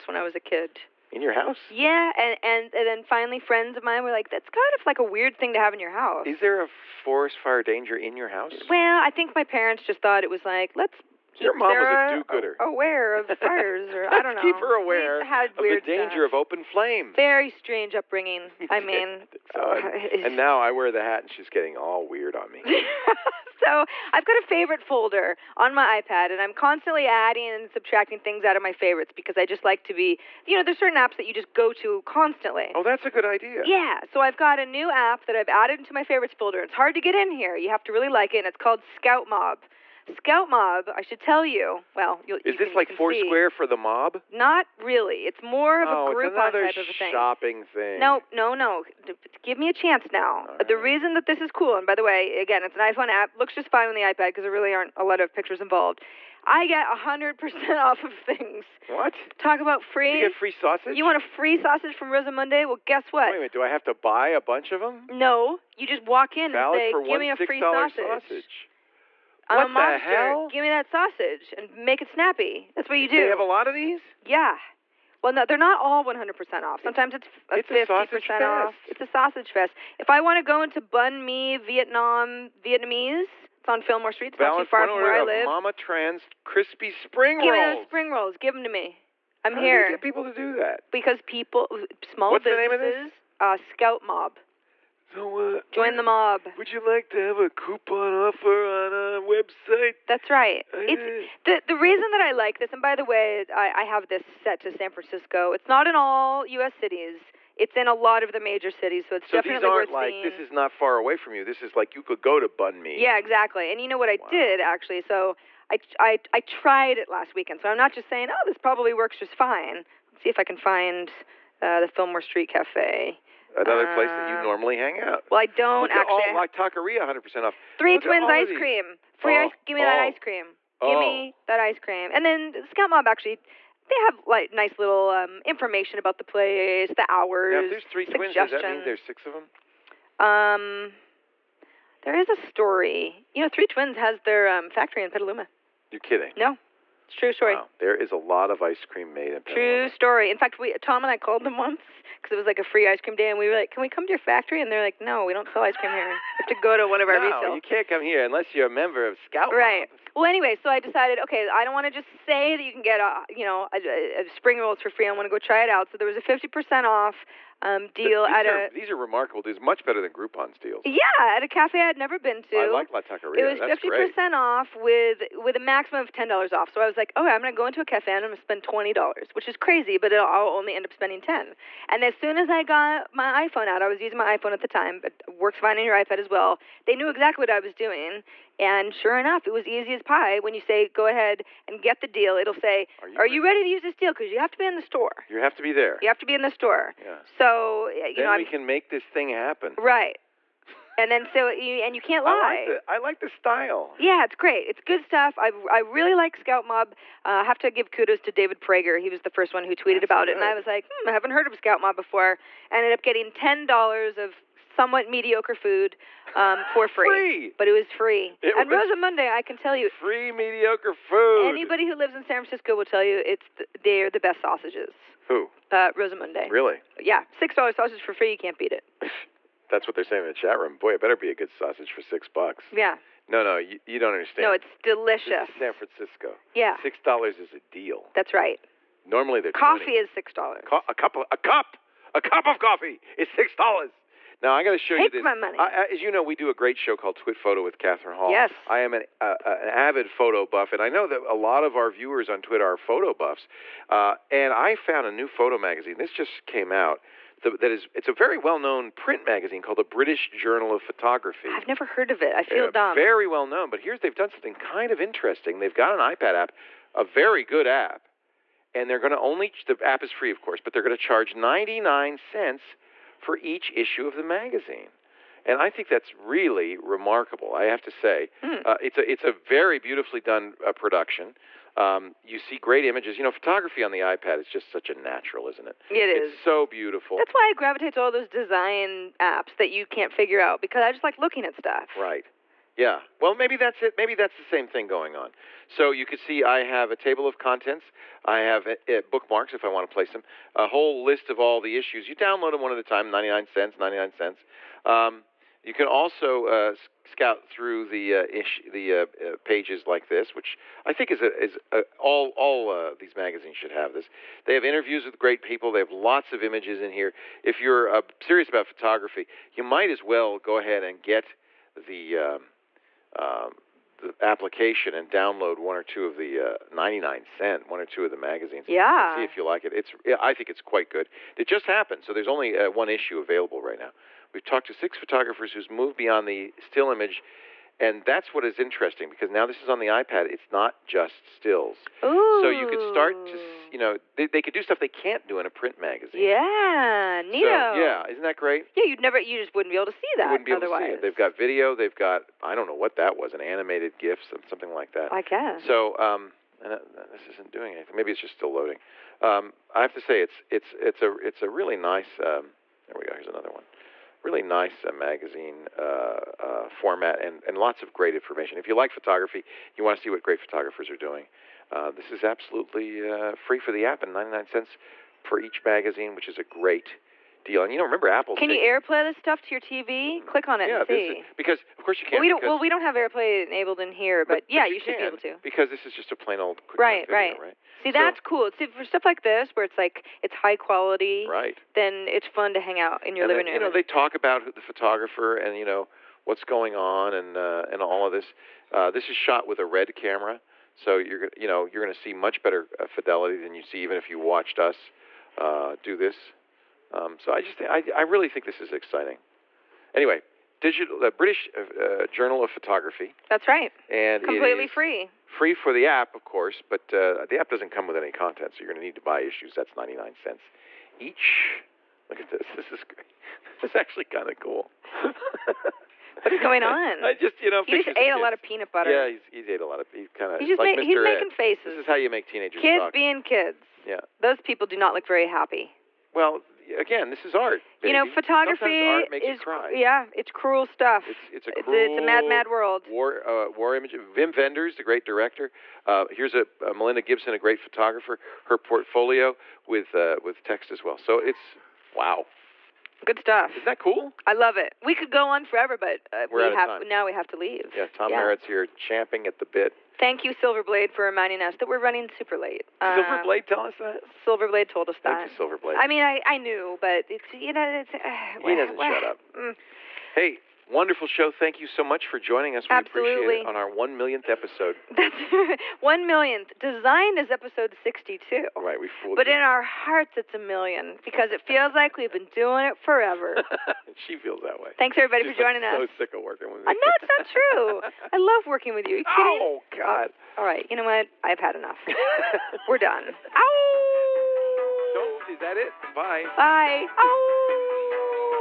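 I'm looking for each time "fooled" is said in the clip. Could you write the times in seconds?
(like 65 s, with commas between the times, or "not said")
478 s.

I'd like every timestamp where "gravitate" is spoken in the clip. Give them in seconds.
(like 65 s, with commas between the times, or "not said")
287 s.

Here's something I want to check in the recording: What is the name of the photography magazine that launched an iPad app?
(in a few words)
British Journal of Photography.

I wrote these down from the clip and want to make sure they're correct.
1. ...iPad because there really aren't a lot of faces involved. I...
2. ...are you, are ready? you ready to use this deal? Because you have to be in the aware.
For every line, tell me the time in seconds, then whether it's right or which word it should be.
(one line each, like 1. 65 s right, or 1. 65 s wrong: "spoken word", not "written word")
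1. 54 s wrong: "pictures", not "faces"
2. 193 s wrong: "store", not "aware".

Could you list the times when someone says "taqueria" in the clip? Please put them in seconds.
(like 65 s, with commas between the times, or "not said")
126 s, 173 s.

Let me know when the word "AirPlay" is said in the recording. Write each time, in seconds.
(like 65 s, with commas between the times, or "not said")
378 s, 382 s.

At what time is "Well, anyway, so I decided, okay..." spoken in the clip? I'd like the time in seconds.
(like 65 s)
160 s.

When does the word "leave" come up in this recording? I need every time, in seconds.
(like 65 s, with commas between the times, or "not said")
457 s.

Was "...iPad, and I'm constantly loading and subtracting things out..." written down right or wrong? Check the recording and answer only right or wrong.
wrong.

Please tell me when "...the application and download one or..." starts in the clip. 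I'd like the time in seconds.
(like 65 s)
323 s.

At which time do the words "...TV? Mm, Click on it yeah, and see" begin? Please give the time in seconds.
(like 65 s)
379 s.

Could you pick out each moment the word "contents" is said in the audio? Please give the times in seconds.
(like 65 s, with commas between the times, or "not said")
297 s, 418 s.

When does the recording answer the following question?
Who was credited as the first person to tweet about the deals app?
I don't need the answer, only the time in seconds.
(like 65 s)
208 s.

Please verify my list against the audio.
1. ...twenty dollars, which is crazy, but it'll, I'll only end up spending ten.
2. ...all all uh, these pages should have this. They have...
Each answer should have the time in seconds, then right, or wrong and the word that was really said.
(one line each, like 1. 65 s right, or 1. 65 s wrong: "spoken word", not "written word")
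1. 178 s right
2. 311 s wrong: "magazines", not "pages".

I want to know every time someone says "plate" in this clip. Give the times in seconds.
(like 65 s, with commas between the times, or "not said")
not said.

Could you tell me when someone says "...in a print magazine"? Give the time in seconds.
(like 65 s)
345 s.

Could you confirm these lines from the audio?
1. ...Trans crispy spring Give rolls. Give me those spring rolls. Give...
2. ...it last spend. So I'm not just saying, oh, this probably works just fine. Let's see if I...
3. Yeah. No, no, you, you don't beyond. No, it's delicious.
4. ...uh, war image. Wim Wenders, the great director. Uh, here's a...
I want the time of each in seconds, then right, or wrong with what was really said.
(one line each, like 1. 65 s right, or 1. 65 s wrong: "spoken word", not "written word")
1. 85 s right
2. 116 s wrong: "weekend", not "spend"
3. 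232 s wrong: "understand", not "beyond"
4. 443 s right.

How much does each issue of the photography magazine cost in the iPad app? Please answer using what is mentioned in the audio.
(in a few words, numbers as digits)
99 cents.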